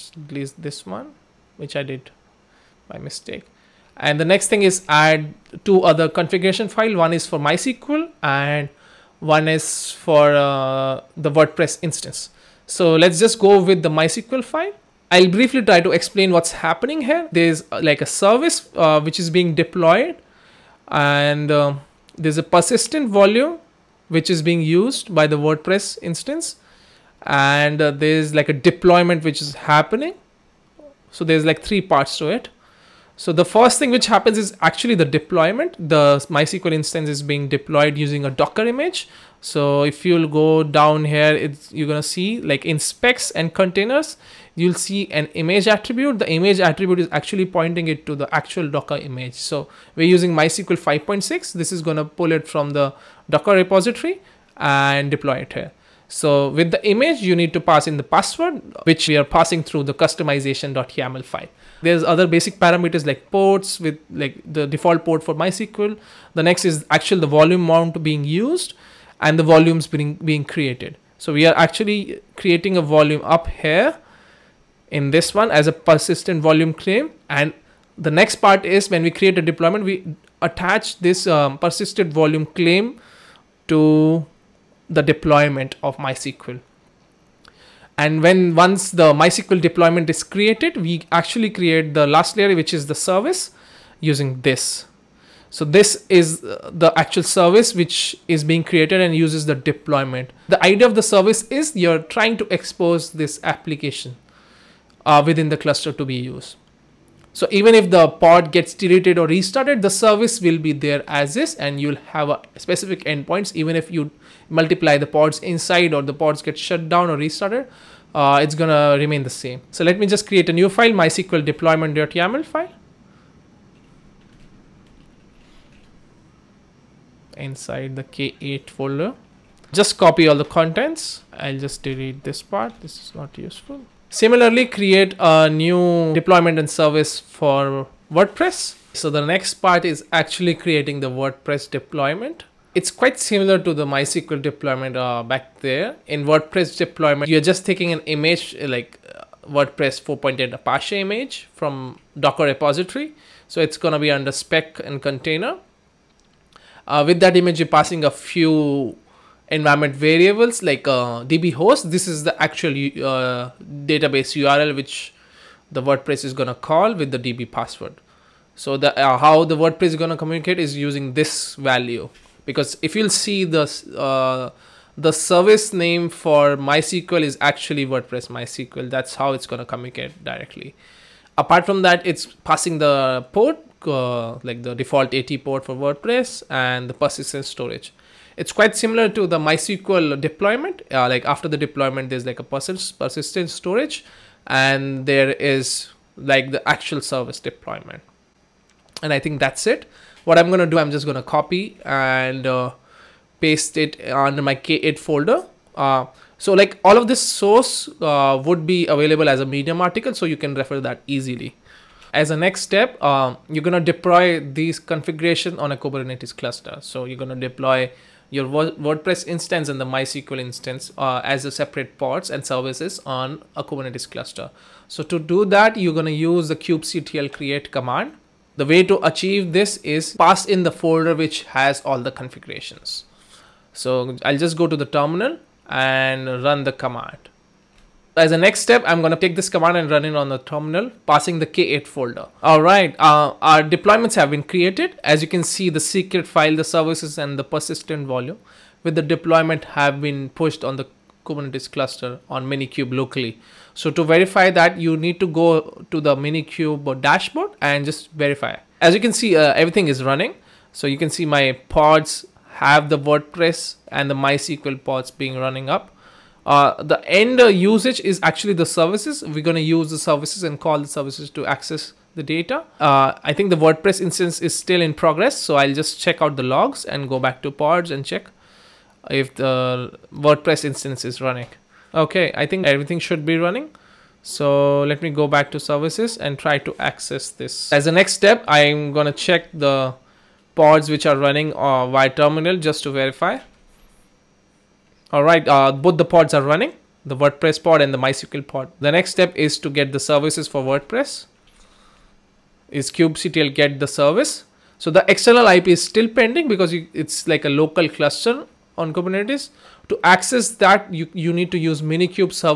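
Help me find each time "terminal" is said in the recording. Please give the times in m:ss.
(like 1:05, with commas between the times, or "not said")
3:54, 4:00, 4:52.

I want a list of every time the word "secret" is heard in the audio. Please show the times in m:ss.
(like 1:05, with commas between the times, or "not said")
4:05.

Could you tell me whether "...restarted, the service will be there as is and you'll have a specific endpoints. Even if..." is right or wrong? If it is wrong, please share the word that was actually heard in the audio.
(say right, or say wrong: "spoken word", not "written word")
right.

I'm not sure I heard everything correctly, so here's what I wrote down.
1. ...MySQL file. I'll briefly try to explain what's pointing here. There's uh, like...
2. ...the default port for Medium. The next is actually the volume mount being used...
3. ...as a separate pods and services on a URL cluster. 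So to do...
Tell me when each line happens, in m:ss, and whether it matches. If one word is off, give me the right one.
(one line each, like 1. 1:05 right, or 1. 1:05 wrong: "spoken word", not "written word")
1. 0:13 wrong: "happening", not "pointing"
2. 1:04 wrong: "MySQL", not "Medium"
3. 3:41 wrong: "Kubernetes", not "URL".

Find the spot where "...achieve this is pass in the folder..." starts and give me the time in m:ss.
3:49.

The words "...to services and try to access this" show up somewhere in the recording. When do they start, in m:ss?
4:45.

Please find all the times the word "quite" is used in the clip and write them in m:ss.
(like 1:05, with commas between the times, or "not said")
2:22, 3:08.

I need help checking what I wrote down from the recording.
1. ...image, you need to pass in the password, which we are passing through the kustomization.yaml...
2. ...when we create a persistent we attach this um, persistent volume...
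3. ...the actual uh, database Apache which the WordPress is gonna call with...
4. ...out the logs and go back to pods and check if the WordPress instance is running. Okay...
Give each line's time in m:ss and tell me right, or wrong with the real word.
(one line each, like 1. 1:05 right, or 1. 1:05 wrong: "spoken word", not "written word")
1. 0:56 right
2. 1:18 wrong: "deployment", not "persistent"
3. 2:42 wrong: "URL", not "Apache"
4. 4:36 right.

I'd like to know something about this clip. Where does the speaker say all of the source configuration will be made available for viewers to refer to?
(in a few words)
Medium article.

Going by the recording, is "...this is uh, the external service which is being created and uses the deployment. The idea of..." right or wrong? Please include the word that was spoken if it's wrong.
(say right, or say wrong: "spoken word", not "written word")
wrong: "actual", not "external".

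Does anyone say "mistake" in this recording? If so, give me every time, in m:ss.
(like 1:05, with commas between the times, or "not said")
0:02.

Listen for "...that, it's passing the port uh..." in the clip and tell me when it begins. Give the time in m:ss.
3:01.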